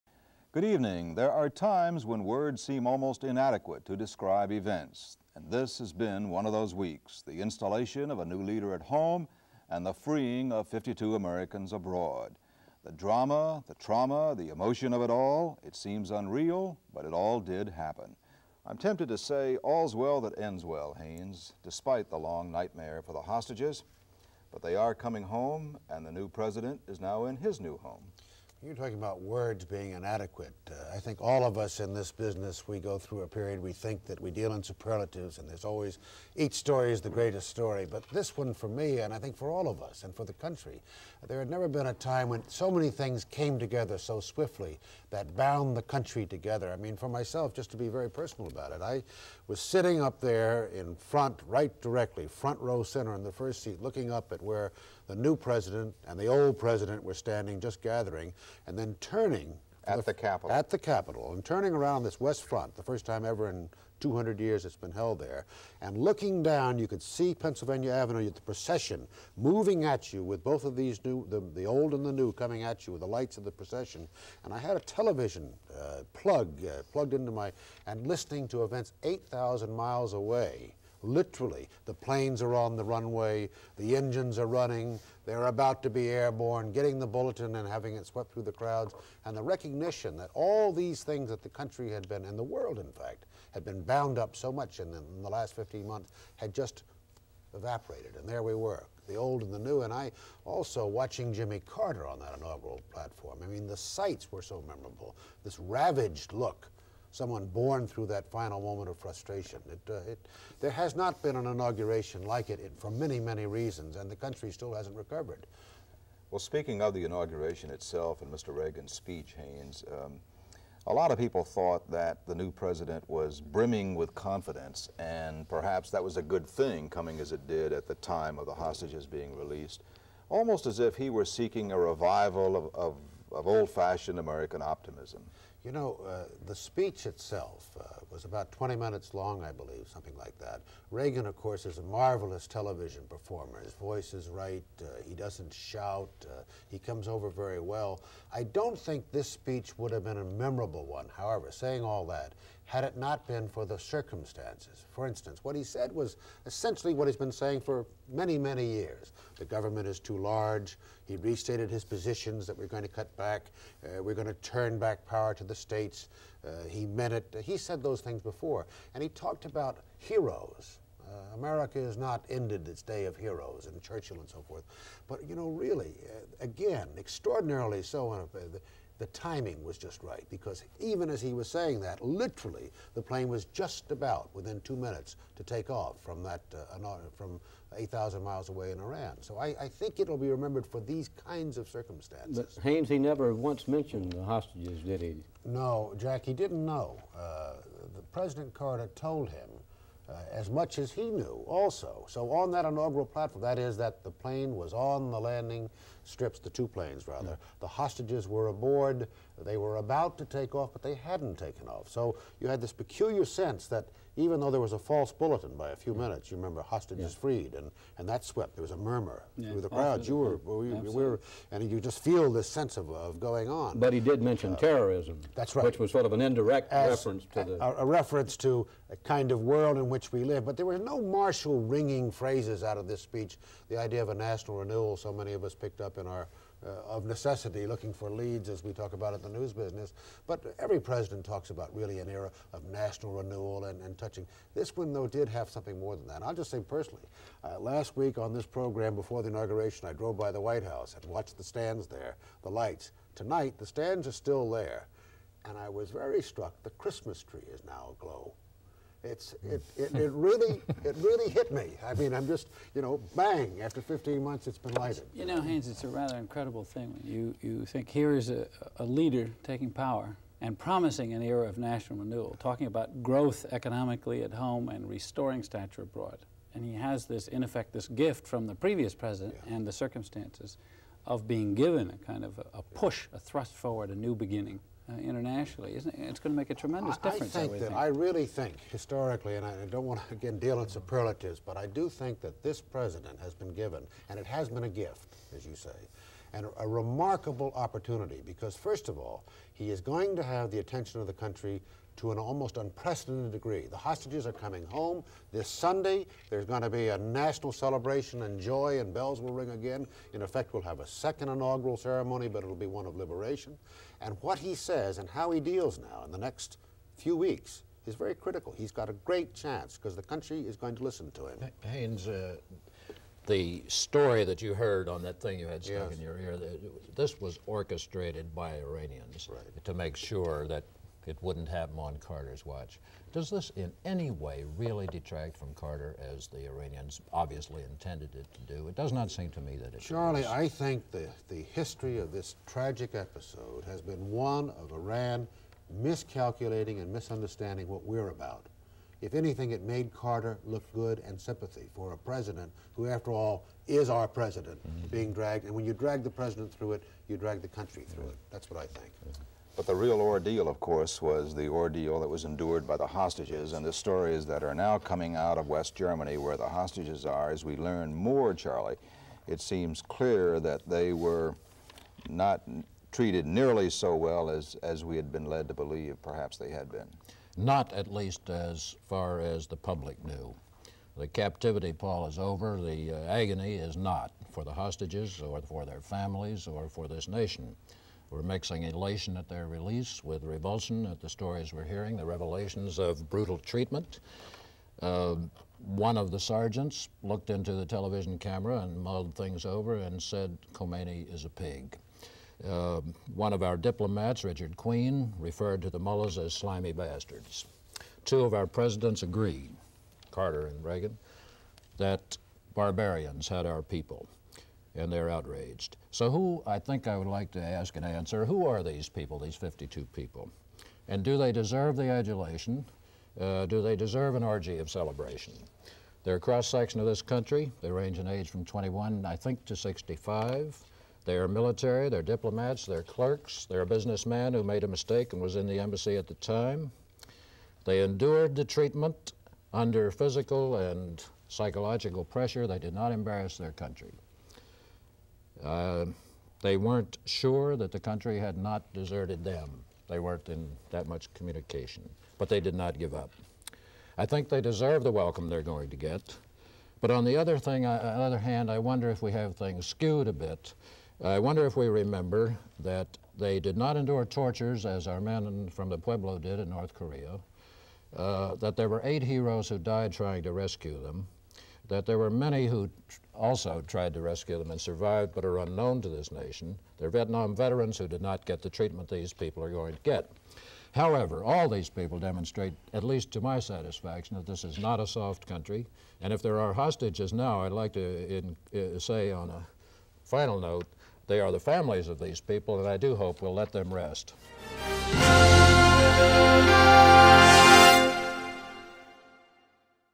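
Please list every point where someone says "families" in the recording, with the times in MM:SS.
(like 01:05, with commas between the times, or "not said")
06:25, 08:11.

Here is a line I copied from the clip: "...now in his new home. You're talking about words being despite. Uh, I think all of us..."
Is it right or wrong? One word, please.
wrong.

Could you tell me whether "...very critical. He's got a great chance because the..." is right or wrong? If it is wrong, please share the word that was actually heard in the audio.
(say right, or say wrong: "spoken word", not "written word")
right.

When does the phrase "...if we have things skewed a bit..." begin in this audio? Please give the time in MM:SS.
07:38.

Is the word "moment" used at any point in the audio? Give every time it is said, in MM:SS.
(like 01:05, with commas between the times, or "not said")
01:48.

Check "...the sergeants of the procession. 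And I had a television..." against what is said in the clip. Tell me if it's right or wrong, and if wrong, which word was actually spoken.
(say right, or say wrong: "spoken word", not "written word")
wrong: "lights", not "sergeants".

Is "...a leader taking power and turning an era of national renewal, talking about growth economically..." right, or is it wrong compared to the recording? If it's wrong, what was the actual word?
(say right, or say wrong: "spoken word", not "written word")
wrong: "promising", not "turning".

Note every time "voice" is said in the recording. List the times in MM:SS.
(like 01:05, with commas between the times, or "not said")
02:23.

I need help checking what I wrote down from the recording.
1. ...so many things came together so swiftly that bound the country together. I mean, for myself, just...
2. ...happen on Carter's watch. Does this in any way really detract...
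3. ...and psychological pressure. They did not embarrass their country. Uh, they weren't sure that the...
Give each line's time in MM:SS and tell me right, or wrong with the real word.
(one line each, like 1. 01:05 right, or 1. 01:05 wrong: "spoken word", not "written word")
1. 00:42 right
2. 05:31 right
3. 07:20 right.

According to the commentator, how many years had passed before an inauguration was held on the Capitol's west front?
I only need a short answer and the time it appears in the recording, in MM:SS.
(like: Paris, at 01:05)
200, at 01:03.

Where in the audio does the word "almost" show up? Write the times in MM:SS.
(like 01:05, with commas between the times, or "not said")
00:02, 02:10, 05:02.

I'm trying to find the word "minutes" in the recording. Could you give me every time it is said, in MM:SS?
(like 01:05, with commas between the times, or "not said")
02:18, 03:04, 03:35.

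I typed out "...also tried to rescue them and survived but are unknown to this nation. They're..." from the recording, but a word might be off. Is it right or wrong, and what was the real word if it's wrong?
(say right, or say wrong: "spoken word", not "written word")
right.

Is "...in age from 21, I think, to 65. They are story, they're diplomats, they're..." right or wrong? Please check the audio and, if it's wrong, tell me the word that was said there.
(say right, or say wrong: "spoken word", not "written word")
wrong: "military", not "story".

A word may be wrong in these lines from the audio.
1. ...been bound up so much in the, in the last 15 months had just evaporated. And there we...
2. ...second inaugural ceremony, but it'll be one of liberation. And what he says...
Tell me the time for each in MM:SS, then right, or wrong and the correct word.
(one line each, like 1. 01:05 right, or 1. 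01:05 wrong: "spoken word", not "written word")
1. 01:33 right
2. 05:10 right.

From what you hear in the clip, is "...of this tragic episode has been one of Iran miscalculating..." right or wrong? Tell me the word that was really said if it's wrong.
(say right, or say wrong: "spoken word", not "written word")
right.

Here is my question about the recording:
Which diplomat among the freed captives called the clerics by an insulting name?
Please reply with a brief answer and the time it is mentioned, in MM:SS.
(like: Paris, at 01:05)
Richard Queen, at 06:44.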